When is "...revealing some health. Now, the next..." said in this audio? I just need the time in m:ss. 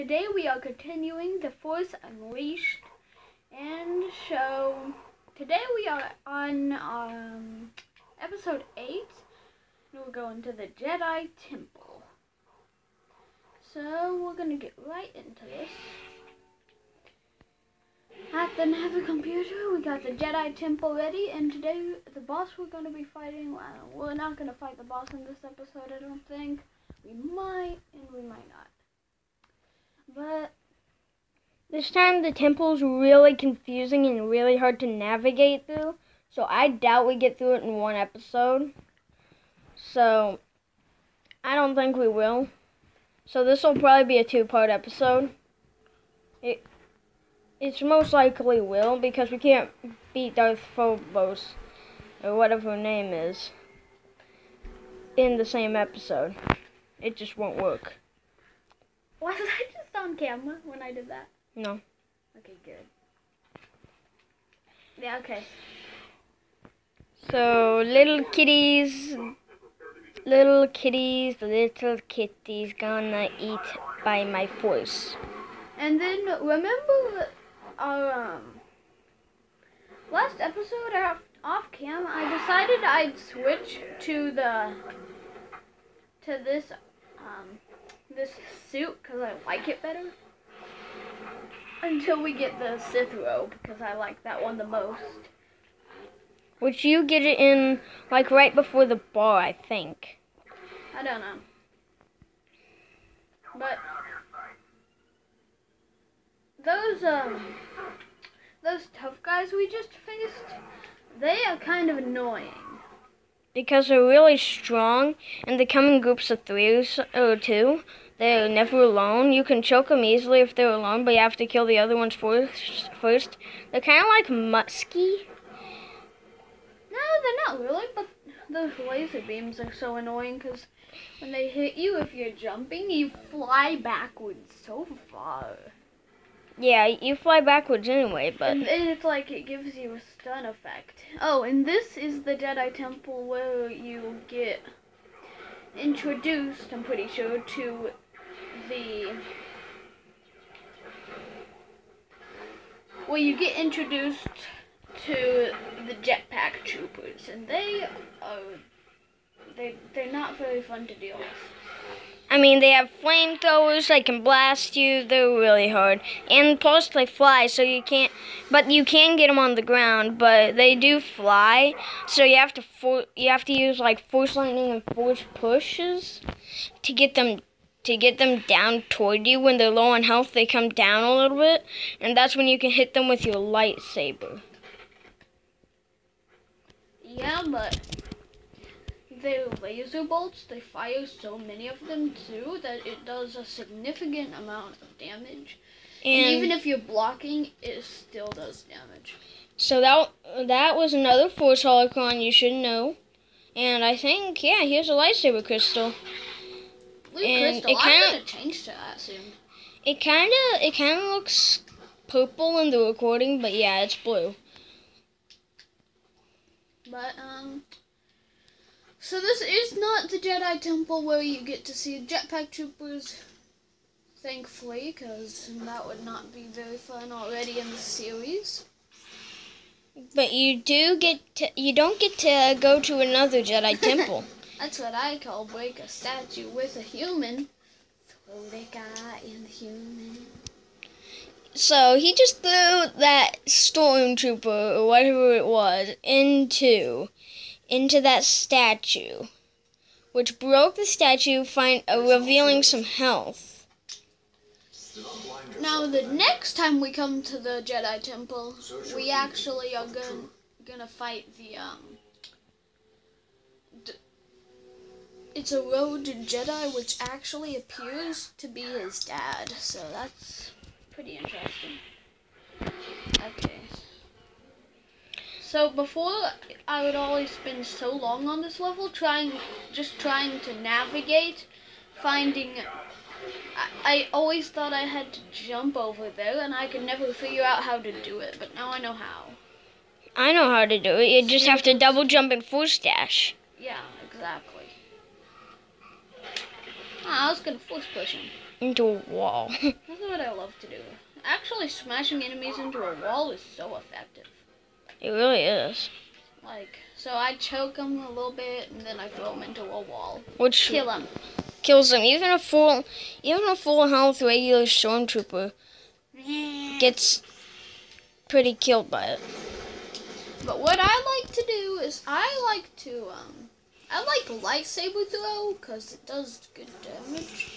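4:12.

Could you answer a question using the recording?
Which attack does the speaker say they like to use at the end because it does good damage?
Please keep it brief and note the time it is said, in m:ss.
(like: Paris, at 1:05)
Lightsaber throw, at 5:24.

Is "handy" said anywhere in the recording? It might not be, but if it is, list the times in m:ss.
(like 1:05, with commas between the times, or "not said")
not said.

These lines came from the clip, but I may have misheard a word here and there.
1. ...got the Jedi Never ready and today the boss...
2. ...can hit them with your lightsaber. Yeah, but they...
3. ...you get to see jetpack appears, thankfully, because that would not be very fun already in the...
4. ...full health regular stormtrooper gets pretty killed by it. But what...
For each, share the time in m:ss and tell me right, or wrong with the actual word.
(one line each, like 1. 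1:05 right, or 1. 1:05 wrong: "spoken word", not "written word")
1. 0:19 wrong: "Temple", not "Never"
2. 3:02 right
3. 3:41 wrong: "troopers", not "appears"
4. 5:13 right.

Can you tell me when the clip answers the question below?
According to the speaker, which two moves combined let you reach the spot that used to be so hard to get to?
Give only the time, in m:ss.
4:51.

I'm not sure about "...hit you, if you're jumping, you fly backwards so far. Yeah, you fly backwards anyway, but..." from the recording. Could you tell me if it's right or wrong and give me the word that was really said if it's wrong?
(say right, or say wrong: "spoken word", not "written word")
right.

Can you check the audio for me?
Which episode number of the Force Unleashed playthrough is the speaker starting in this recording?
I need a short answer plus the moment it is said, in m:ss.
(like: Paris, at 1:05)
8, at 0:08.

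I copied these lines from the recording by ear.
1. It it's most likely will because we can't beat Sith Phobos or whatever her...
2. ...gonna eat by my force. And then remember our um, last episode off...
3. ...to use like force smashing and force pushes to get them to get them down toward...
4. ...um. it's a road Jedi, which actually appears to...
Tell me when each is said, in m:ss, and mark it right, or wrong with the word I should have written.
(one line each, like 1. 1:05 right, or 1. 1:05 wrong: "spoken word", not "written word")
1. 0:46 wrong: "Darth", not "Sith"
2. 1:12 right
3. 2:53 wrong: "lightning", not "smashing"
4. 4:21 right.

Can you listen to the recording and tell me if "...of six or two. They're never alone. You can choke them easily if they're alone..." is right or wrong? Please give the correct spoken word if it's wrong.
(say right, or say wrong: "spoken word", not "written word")
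wrong: "three", not "six".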